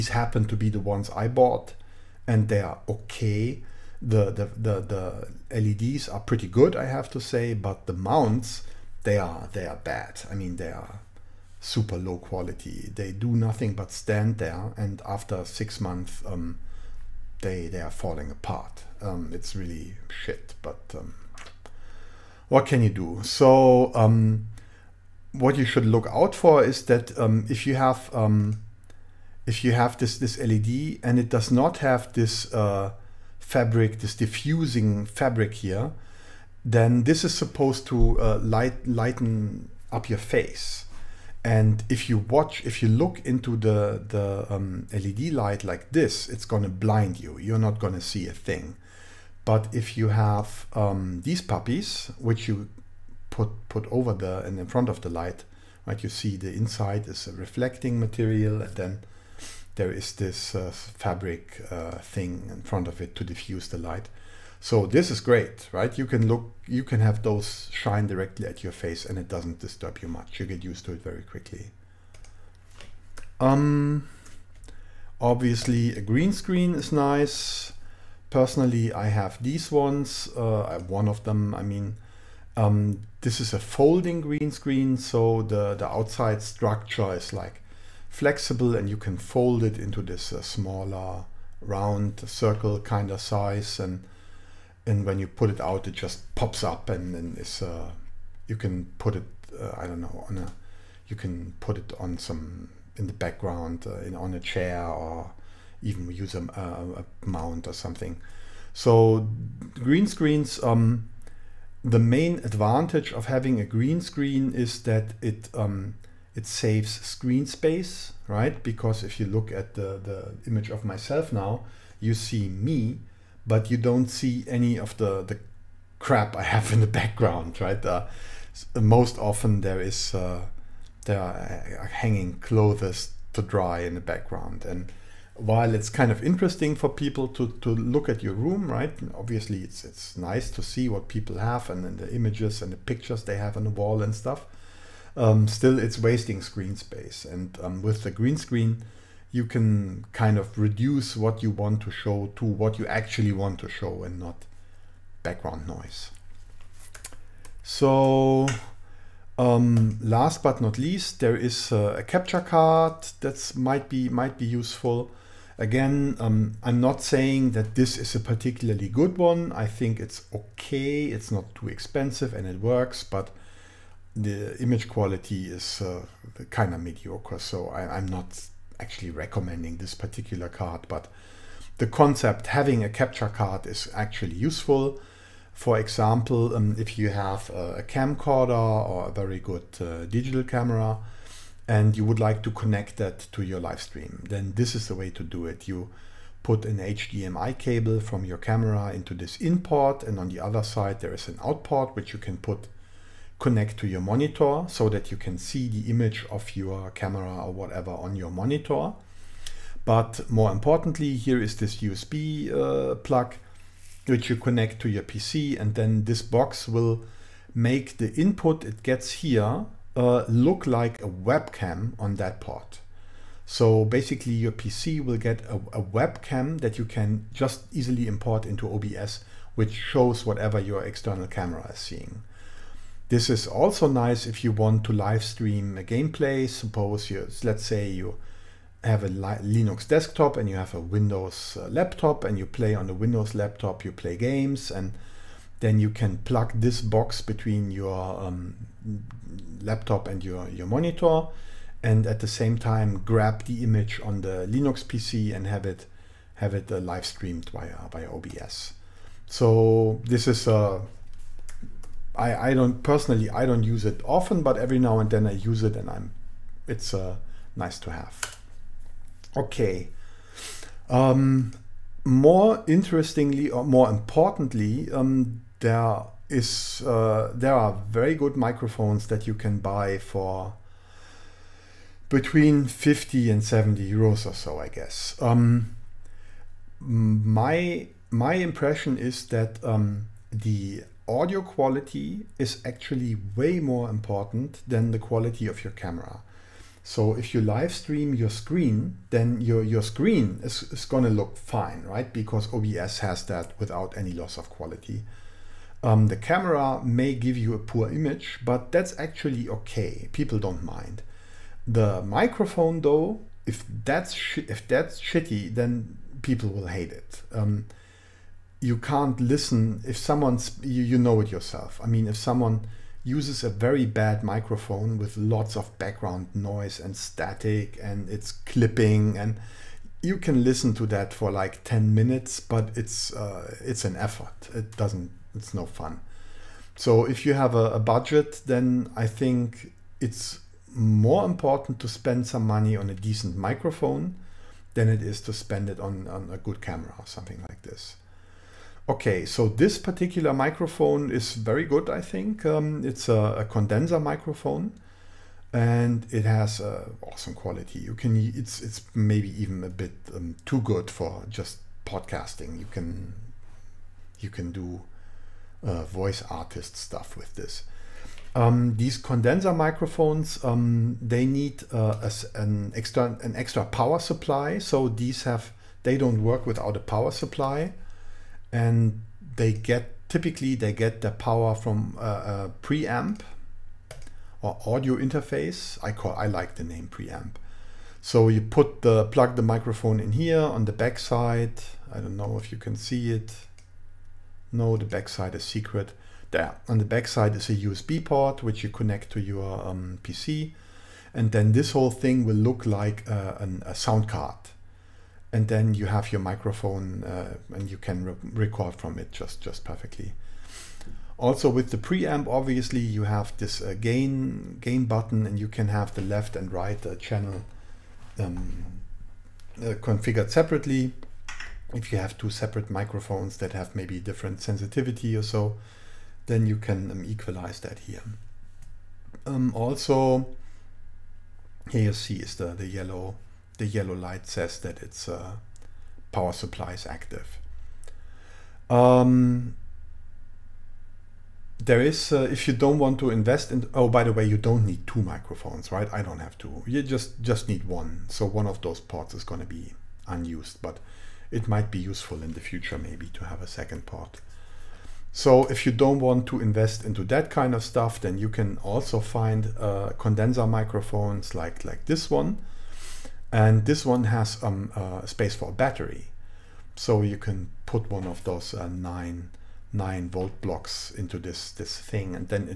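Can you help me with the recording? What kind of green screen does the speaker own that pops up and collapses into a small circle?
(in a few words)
Folding green screen.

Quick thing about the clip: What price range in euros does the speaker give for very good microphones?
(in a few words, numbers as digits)
50 to 70 euros.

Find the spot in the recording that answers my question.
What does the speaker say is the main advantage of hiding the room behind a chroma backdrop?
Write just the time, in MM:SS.
01:56.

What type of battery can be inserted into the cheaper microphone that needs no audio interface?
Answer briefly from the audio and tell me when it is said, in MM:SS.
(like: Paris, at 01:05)
9 volt block, at 07:49.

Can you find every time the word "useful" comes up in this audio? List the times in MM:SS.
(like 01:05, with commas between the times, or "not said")
02:44, 03:04, 07:31.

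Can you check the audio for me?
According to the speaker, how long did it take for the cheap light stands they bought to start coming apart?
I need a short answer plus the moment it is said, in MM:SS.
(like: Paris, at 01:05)
6 months, at 00:15.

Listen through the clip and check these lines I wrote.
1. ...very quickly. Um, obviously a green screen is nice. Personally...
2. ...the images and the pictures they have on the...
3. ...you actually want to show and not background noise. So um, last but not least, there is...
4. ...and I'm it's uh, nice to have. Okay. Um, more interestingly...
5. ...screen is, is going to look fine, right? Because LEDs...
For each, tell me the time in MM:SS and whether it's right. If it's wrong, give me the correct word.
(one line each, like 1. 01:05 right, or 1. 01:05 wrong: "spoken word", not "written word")
1. 01:11 right
2. 02:21 right
3. 02:32 right
4. 04:25 right
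5. 04:59 wrong: "OBS", not "LEDs".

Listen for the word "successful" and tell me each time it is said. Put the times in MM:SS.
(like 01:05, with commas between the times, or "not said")
not said.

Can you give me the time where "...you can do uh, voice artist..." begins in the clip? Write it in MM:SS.
06:04.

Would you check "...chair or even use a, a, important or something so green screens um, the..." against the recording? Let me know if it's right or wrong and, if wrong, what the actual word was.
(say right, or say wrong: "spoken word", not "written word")
wrong: "mount", not "important".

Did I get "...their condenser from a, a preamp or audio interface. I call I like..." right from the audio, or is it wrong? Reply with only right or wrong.
wrong.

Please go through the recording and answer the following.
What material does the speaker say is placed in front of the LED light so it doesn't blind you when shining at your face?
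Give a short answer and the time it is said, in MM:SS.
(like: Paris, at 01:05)
Diffusing fabric, at 00:34.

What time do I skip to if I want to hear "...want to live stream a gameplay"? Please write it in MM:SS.
03:54.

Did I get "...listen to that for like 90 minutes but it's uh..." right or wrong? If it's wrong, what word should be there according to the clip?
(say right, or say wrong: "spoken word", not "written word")
wrong: "10", not "90".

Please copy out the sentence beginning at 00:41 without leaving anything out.
And if you watch, if you look into the, the um, LED light like this, it's gonna blind you.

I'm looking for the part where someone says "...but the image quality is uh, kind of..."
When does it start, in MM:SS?
02:53.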